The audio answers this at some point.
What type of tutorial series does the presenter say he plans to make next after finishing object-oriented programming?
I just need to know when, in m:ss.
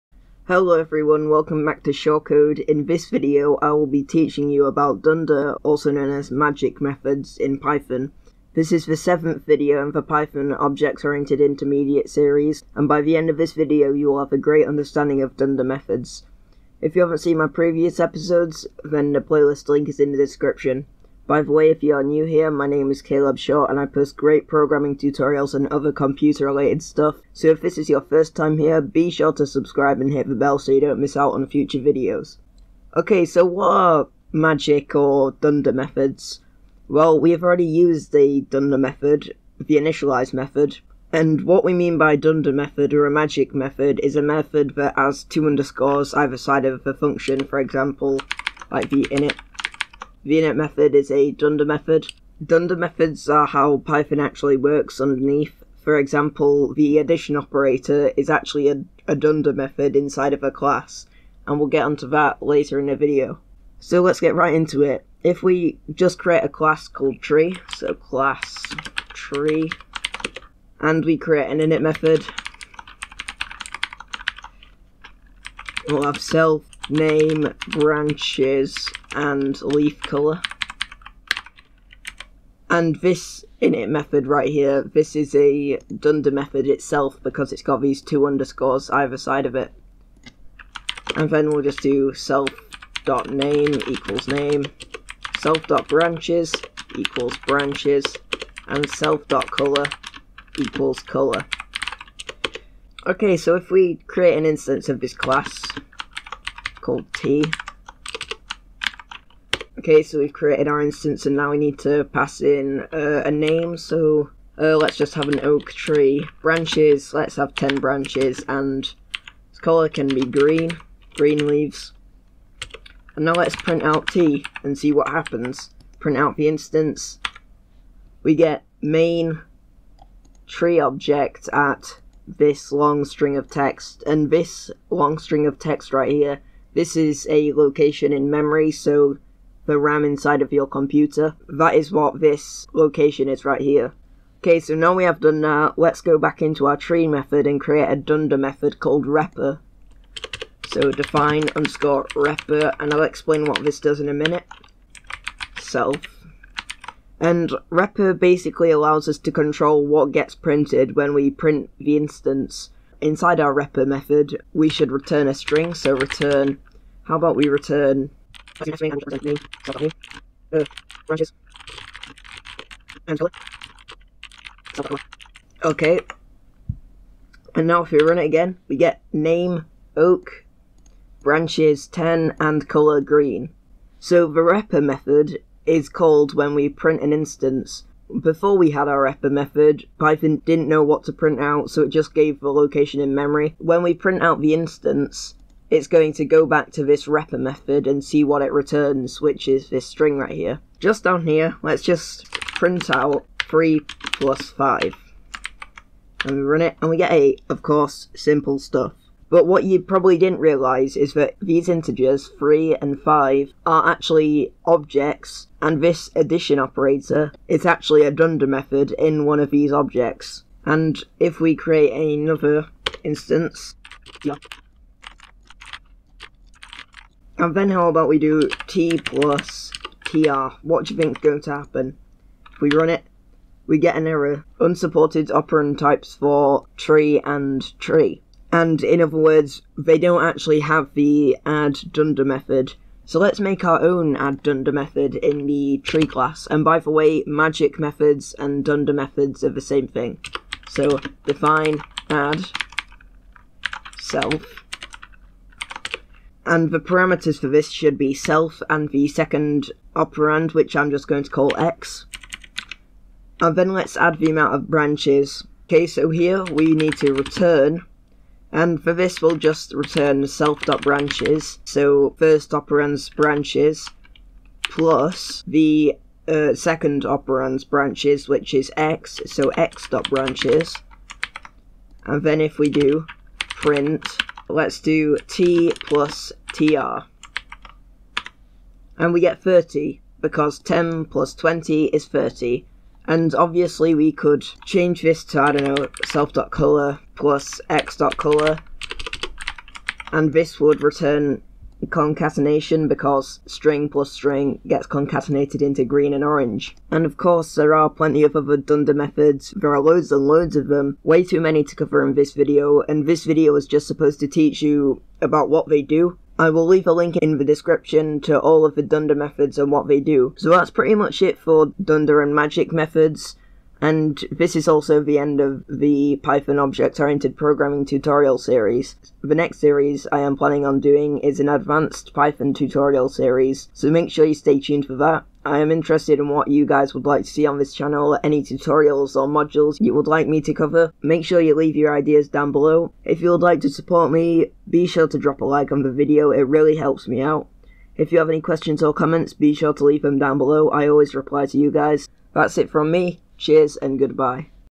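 5:31.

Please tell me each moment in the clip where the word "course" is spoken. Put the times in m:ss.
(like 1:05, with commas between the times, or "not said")
3:27, 5:07.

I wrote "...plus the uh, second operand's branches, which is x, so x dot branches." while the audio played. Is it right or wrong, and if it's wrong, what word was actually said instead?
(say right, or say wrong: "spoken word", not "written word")
right.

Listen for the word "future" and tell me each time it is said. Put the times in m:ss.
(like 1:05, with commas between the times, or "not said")
0:31.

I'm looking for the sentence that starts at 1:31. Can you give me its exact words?
And then we'll just do self dot name equals name, self dot branches equals branches, and self dot color equals color.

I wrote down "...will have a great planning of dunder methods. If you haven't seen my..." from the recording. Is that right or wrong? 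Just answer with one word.
wrong.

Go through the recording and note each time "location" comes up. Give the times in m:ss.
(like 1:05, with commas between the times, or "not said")
2:17, 2:22, 3:12.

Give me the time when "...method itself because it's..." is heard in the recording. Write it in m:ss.
1:26.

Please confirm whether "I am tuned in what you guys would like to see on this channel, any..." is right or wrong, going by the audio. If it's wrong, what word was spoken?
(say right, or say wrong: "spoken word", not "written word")
wrong: "interested", not "tuned".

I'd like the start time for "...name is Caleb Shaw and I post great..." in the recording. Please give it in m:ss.
0:22.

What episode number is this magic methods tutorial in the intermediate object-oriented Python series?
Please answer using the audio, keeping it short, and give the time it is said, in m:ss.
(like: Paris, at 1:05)
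seventh, at 0:08.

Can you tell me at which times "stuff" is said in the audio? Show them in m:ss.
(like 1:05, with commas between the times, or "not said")
0:26, 3:28.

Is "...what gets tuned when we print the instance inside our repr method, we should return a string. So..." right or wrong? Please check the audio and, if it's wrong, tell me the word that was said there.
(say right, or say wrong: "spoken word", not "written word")
wrong: "printed", not "tuned".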